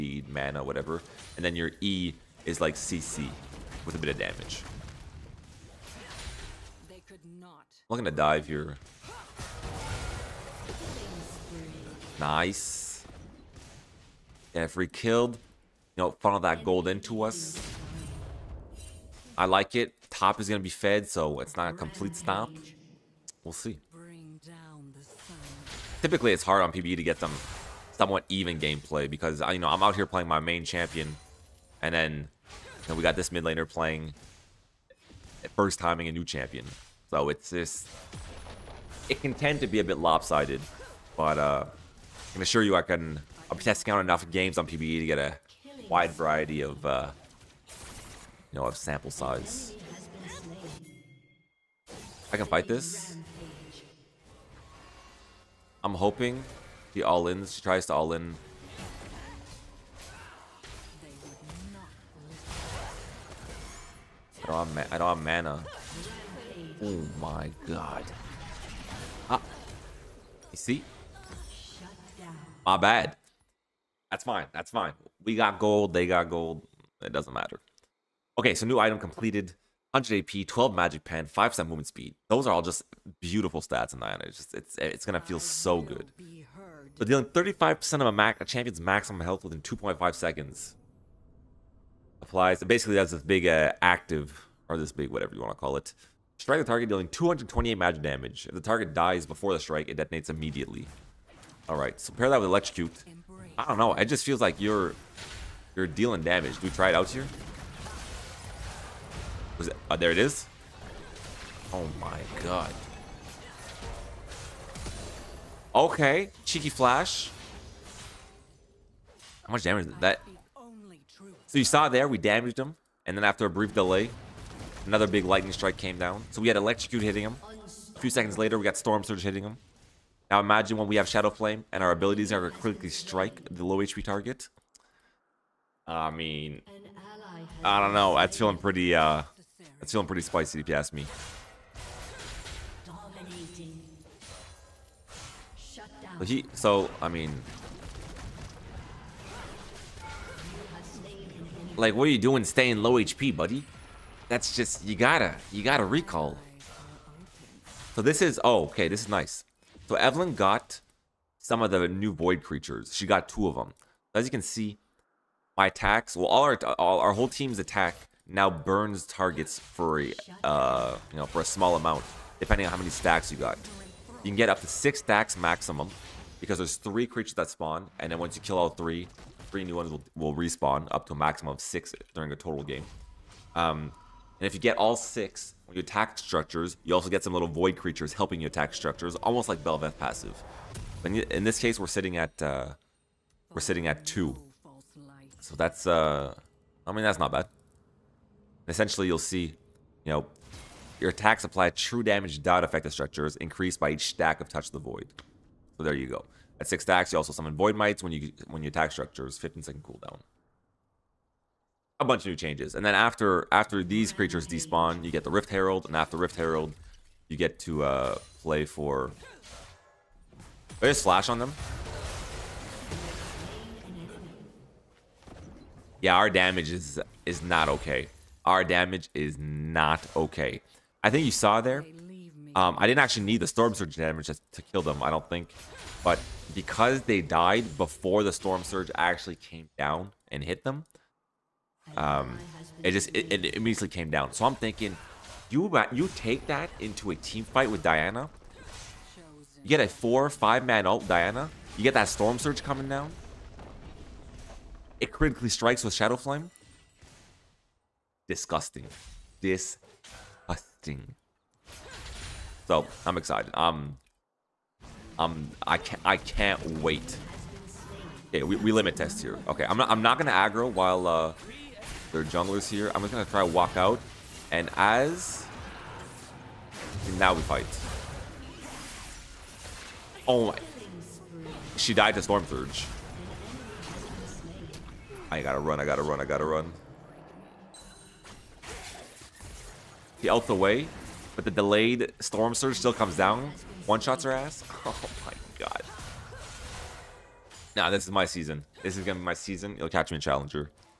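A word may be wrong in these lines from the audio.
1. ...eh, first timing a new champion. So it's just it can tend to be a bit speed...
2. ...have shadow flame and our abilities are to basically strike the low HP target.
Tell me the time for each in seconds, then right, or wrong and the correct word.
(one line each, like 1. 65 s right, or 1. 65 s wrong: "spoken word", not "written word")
1. 35 s wrong: "lopsided", not "speed"
2. 130 s wrong: "critically", not "basically".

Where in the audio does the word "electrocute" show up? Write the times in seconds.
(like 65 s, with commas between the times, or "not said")
102 s, 126 s.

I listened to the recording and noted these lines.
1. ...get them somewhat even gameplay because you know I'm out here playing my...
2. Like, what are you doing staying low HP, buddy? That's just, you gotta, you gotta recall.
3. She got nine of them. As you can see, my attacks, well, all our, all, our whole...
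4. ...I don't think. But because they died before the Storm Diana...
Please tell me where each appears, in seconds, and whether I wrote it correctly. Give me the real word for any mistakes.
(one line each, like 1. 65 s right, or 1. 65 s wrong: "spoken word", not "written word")
1. 27 s right
2. 151 s right
3. 162 s wrong: "two", not "nine"
4. 235 s wrong: "Surge", not "Diana".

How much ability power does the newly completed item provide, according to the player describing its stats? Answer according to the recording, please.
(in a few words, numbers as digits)
100.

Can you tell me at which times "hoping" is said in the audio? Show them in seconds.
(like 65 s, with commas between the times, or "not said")
55 s.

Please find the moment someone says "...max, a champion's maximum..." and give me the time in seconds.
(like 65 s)
88 s.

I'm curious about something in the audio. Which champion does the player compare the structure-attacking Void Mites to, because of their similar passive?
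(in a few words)
Bel'Veth.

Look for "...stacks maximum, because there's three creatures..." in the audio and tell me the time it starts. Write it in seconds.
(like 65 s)
174 s.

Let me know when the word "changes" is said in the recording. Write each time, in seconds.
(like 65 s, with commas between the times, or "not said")
212 s.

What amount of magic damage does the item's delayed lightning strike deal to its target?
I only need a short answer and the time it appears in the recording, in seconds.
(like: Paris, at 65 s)
228, at 97 s.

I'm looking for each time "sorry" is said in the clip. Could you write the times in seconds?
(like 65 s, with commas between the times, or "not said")
not said.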